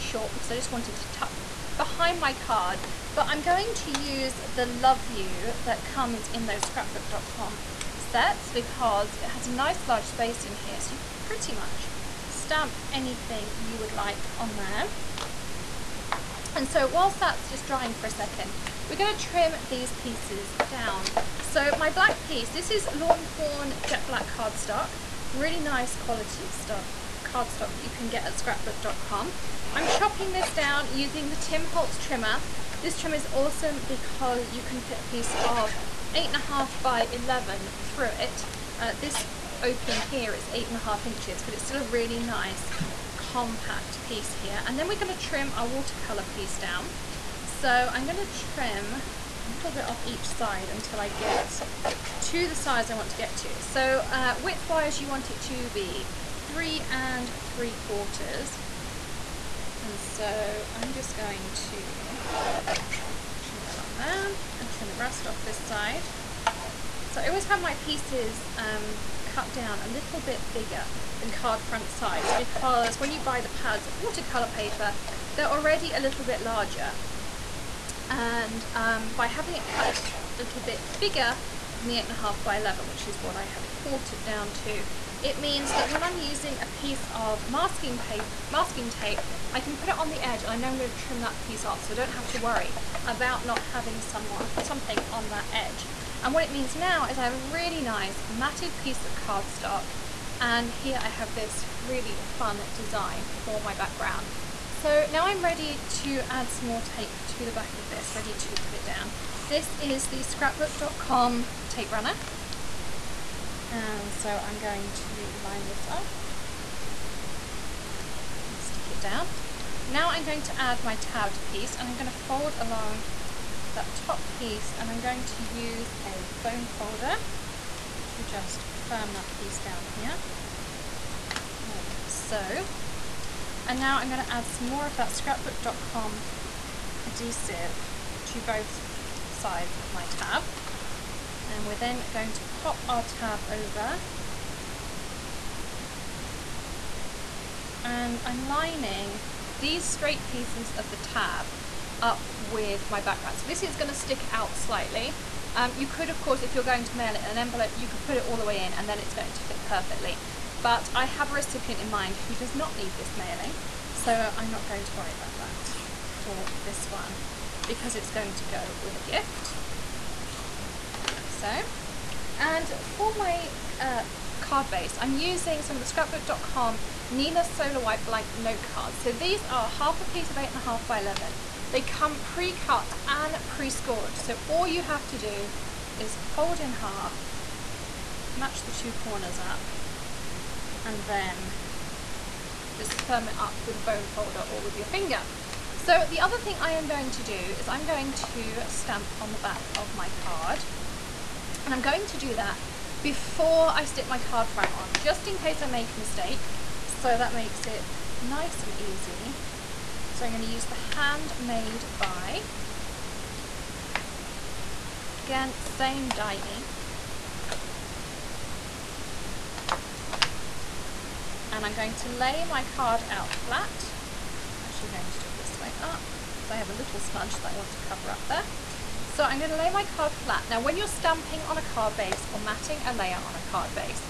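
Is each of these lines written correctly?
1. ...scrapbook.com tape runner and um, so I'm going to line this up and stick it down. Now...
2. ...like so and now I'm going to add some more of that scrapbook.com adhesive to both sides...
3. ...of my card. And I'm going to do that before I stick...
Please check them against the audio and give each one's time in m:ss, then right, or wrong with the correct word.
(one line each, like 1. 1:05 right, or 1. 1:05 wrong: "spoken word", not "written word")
1. 1:50 right
2. 2:11 right
3. 3:19 right.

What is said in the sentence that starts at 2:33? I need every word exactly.
So this is going to stick out slightly.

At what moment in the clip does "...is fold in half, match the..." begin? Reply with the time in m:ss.
3:05.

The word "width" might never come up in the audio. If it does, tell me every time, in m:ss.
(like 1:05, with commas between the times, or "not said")
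0:54.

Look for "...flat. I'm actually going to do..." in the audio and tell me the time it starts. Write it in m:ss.
3:43.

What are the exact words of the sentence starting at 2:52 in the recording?
And for my uh, card base, I'm using some of the scrapbook.com Neenah Solar White blank note cards.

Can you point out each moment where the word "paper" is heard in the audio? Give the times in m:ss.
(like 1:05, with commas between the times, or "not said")
1:14, 1:27.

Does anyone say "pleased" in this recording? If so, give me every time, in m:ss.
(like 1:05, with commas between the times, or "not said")
not said.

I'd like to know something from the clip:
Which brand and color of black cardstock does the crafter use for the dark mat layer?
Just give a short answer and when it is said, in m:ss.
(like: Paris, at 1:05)
Lawn Fawn Jet Black, at 0:22.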